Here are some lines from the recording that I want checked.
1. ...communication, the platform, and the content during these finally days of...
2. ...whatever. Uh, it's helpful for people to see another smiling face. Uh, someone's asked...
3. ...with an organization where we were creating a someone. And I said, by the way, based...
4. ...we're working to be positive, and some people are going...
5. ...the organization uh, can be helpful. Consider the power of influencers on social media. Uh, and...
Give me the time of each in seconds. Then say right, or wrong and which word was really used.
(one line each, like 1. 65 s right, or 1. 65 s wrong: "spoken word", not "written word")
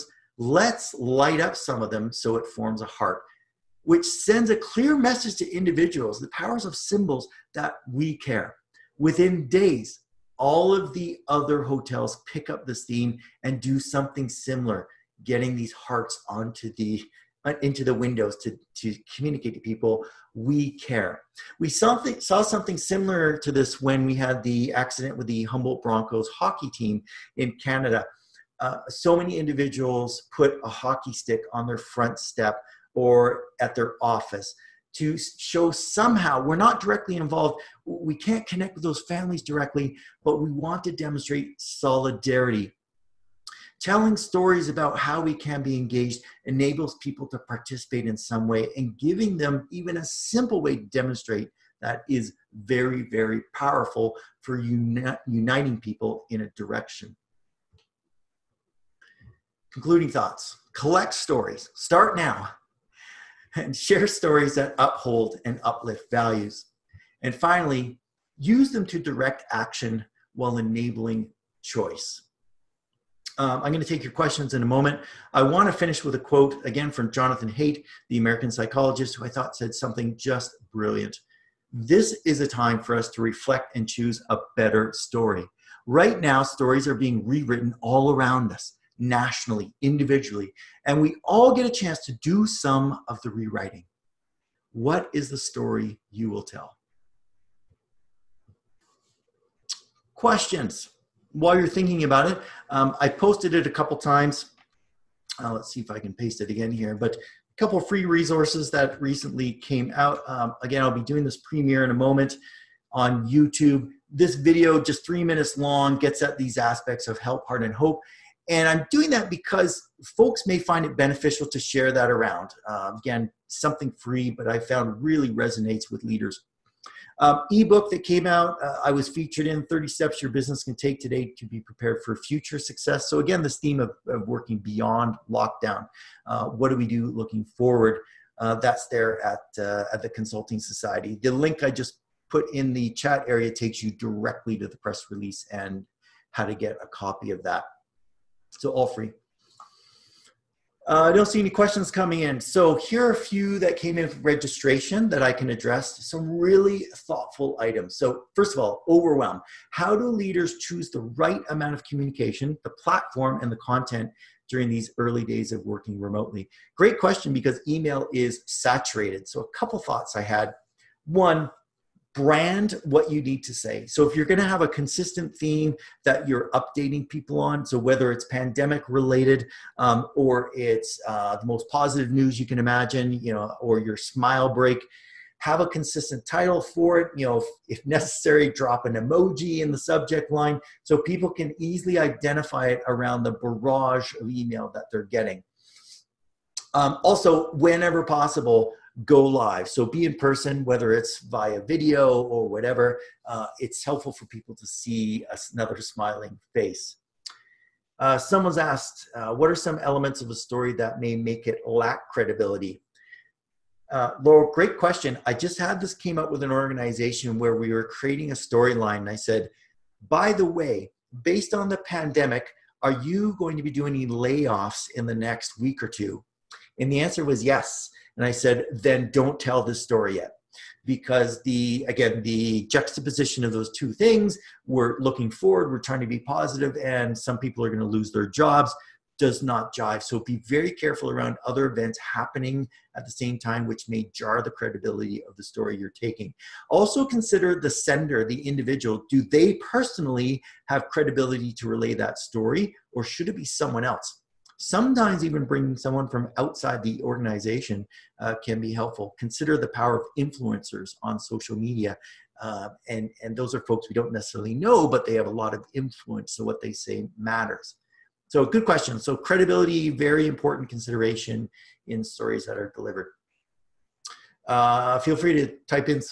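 1. 161 s wrong: "early", not "finally"
2. 202 s right
3. 216 s wrong: "storyline", not "someone"
4. 235 s wrong: "trying", not "working"
5. 256 s right.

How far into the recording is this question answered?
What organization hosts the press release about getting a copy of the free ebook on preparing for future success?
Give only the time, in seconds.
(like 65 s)
140 s.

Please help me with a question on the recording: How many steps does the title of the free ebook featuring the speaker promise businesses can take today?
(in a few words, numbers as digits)
30.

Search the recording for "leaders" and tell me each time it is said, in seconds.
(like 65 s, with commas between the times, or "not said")
126 s, 160 s.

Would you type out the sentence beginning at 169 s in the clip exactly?
So a couple thoughts I had.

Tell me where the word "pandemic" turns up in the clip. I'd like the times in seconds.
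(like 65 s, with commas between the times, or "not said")
178 s, 221 s.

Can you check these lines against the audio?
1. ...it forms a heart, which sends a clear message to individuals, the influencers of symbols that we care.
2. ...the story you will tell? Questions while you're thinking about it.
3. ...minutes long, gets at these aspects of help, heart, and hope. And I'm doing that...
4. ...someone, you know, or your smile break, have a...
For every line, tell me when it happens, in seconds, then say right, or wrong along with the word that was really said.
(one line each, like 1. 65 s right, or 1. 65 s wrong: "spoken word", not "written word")
1. 2 s wrong: "powers", not "influencers"
2. 95 s right
3. 115 s right
4. 182 s wrong: "imagine", not "someone".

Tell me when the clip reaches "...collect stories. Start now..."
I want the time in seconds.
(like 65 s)
60 s.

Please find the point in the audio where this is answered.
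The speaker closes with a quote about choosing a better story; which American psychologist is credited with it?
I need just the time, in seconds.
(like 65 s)
77 s.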